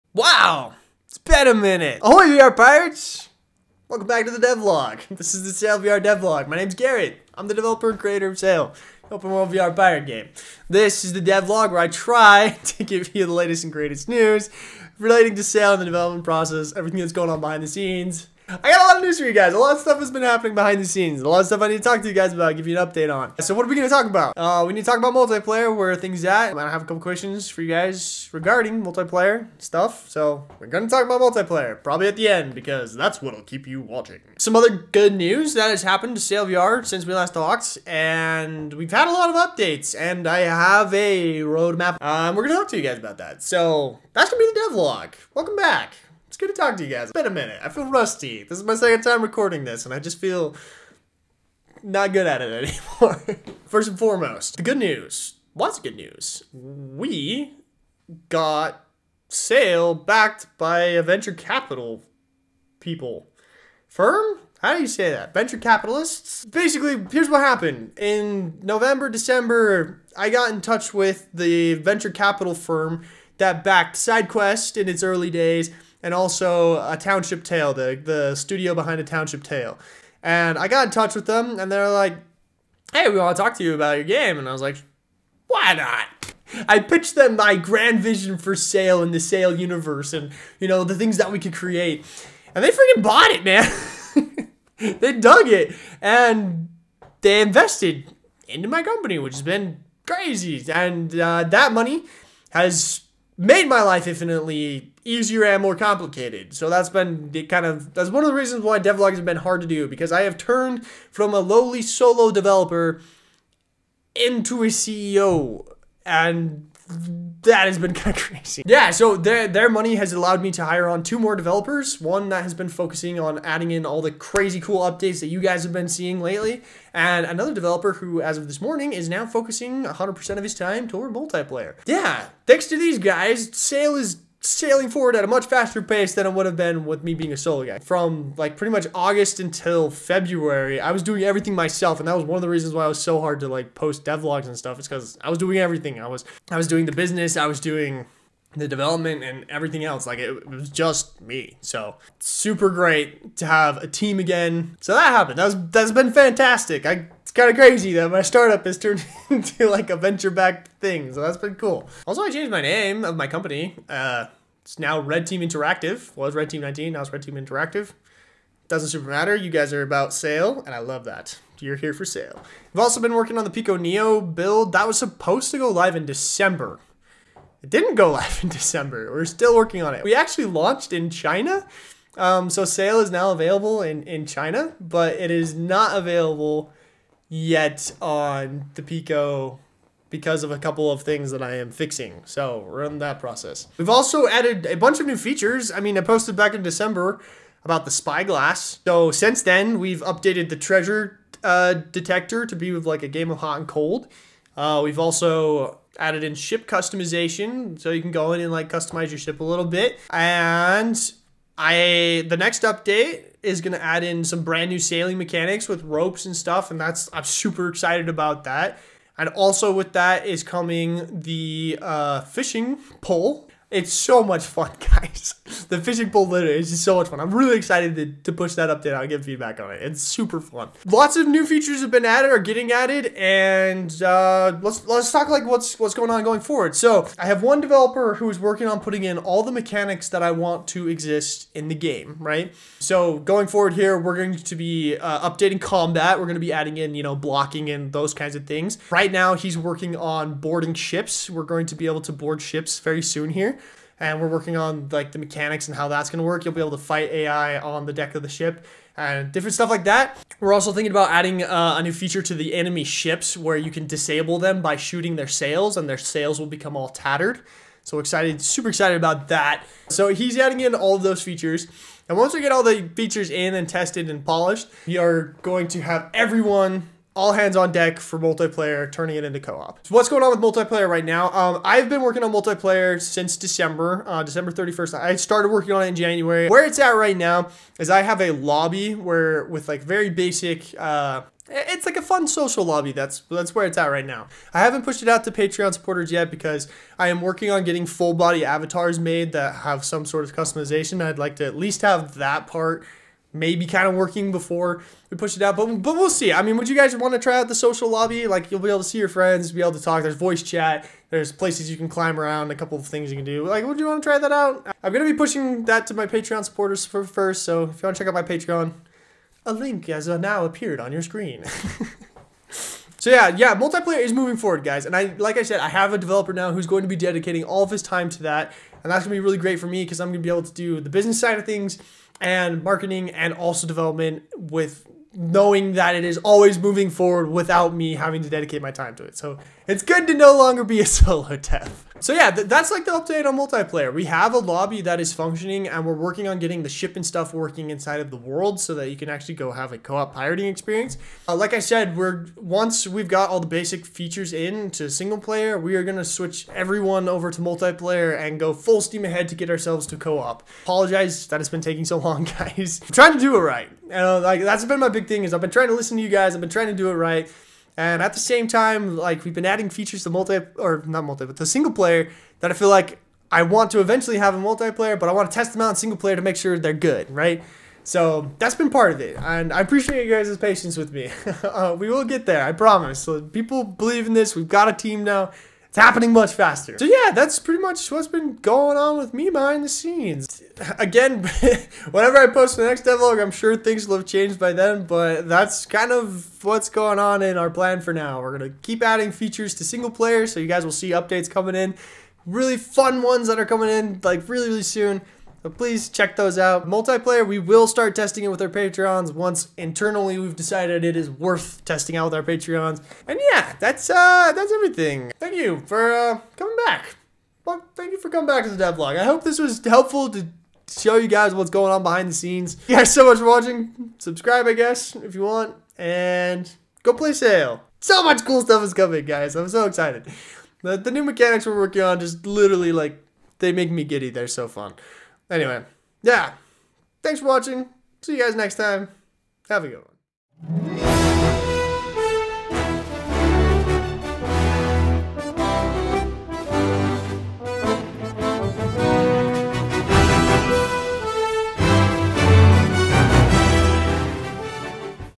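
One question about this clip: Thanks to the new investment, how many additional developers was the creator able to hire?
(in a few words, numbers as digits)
2.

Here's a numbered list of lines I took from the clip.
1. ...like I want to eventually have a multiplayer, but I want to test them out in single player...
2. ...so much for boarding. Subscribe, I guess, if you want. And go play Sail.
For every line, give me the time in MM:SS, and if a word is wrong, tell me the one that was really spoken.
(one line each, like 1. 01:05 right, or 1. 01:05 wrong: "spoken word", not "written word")
1. 06:12 right
2. 07:02 wrong: "watching", not "boarding".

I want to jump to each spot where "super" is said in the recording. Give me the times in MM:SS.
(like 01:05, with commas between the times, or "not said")
02:32, 02:48, 03:37, 03:50, 04:28.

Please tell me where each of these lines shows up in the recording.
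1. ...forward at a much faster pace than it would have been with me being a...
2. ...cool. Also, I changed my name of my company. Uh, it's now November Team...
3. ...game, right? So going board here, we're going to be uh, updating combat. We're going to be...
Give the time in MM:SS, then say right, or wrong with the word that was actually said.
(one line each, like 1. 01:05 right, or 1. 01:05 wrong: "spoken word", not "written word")
1. 02:14 right
2. 02:41 wrong: "Red", not "November"
3. 04:01 wrong: "forward", not "board".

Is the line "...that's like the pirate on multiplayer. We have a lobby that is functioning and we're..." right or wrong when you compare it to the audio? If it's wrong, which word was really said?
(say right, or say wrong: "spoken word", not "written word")
wrong: "update", not "pirate".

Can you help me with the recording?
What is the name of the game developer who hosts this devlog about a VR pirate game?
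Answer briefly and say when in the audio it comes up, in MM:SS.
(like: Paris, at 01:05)
Garrett, at 00:06.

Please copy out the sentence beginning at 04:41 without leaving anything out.
Um, I've been working on multiplayer since December, uh, December 31st.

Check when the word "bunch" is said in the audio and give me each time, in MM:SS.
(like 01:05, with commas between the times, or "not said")
03:14.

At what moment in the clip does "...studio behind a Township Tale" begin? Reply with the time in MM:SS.
01:18.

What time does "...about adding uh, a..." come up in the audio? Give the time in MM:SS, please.
04:20.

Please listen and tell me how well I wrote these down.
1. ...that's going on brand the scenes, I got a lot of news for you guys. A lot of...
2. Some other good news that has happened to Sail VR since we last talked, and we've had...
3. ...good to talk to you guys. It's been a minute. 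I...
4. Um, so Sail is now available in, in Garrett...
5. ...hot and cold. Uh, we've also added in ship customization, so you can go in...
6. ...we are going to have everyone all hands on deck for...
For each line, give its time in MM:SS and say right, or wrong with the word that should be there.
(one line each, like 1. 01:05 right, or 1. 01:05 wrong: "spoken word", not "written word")
1. 00:16 wrong: "behind", not "brand"
2. 00:34 right
3. 00:46 right
4. 03:02 wrong: "China", not "Garrett"
5. 03:23 right
6. 04:34 right.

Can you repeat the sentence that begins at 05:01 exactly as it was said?
I'd like to at least have that part maybe kind of working before we push it out.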